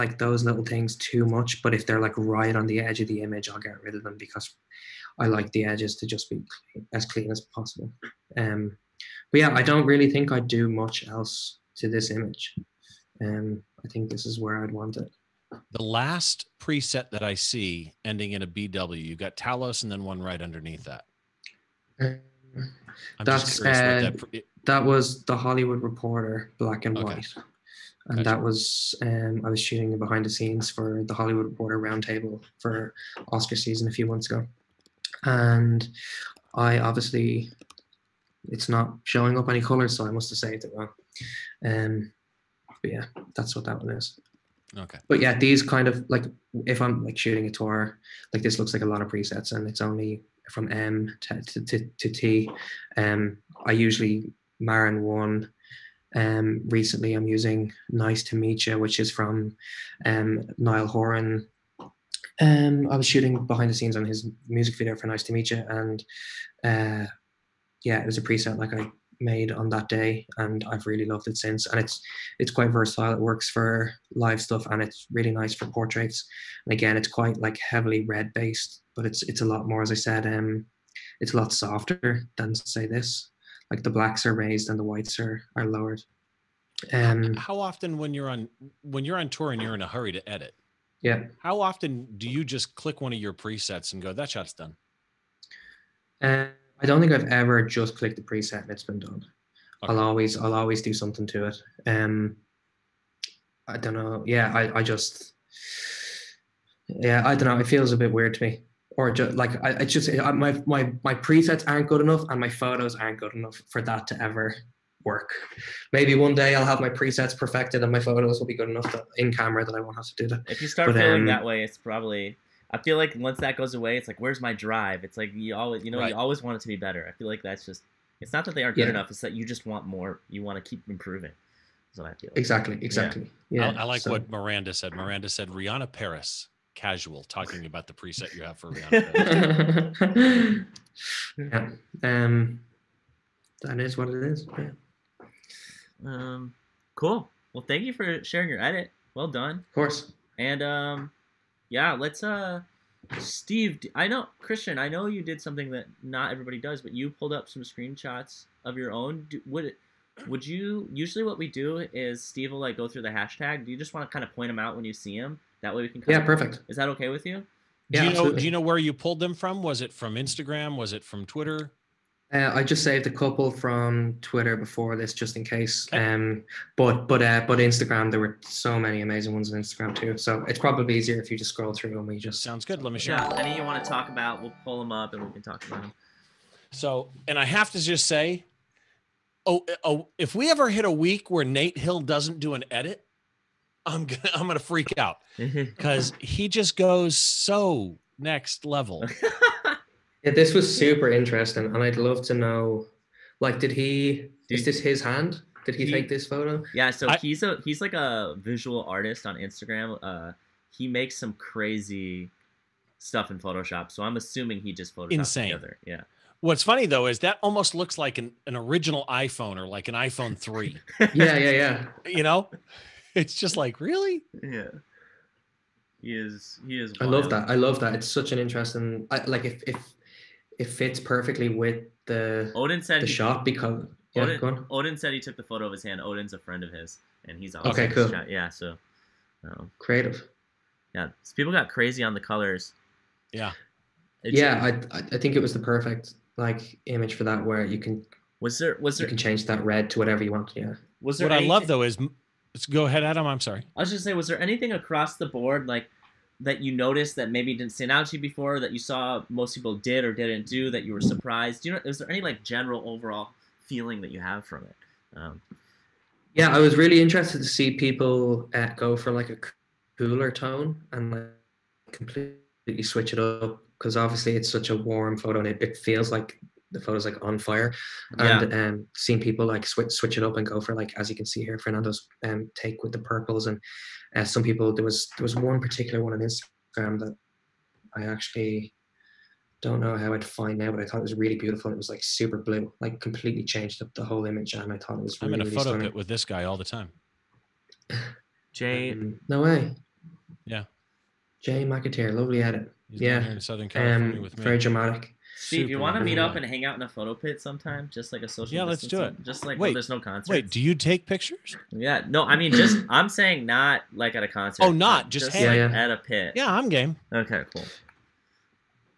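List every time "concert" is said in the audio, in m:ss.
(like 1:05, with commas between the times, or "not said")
5:09, 5:14.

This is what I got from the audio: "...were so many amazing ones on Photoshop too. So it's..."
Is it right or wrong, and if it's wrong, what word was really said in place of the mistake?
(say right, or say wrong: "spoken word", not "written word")
wrong: "Instagram", not "Photoshop".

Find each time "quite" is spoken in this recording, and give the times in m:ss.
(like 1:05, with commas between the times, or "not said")
1:12, 1:17.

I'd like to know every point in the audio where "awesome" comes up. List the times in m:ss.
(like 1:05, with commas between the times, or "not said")
3:57.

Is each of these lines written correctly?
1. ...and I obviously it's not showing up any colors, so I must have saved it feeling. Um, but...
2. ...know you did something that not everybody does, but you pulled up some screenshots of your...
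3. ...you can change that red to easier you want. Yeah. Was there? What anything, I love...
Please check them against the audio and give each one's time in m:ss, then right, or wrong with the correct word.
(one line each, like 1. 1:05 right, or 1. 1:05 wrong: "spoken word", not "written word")
1. 0:35 wrong: "wrong", not "feeling"
2. 2:34 right
3. 4:09 wrong: "whatever", not "easier".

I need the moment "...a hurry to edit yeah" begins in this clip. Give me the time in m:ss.
1:29.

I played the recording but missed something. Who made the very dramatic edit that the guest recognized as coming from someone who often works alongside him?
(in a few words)
Jay McAteer.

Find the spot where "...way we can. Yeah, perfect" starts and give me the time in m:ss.
2:45.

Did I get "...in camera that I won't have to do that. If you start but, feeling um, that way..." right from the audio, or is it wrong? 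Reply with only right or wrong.
right.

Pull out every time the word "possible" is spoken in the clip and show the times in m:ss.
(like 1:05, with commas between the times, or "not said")
0:07.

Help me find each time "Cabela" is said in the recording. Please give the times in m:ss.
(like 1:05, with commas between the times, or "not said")
not said.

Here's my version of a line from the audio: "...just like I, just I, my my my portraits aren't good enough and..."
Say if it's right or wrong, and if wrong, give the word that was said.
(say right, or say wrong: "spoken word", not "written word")
wrong: "presets", not "portraits".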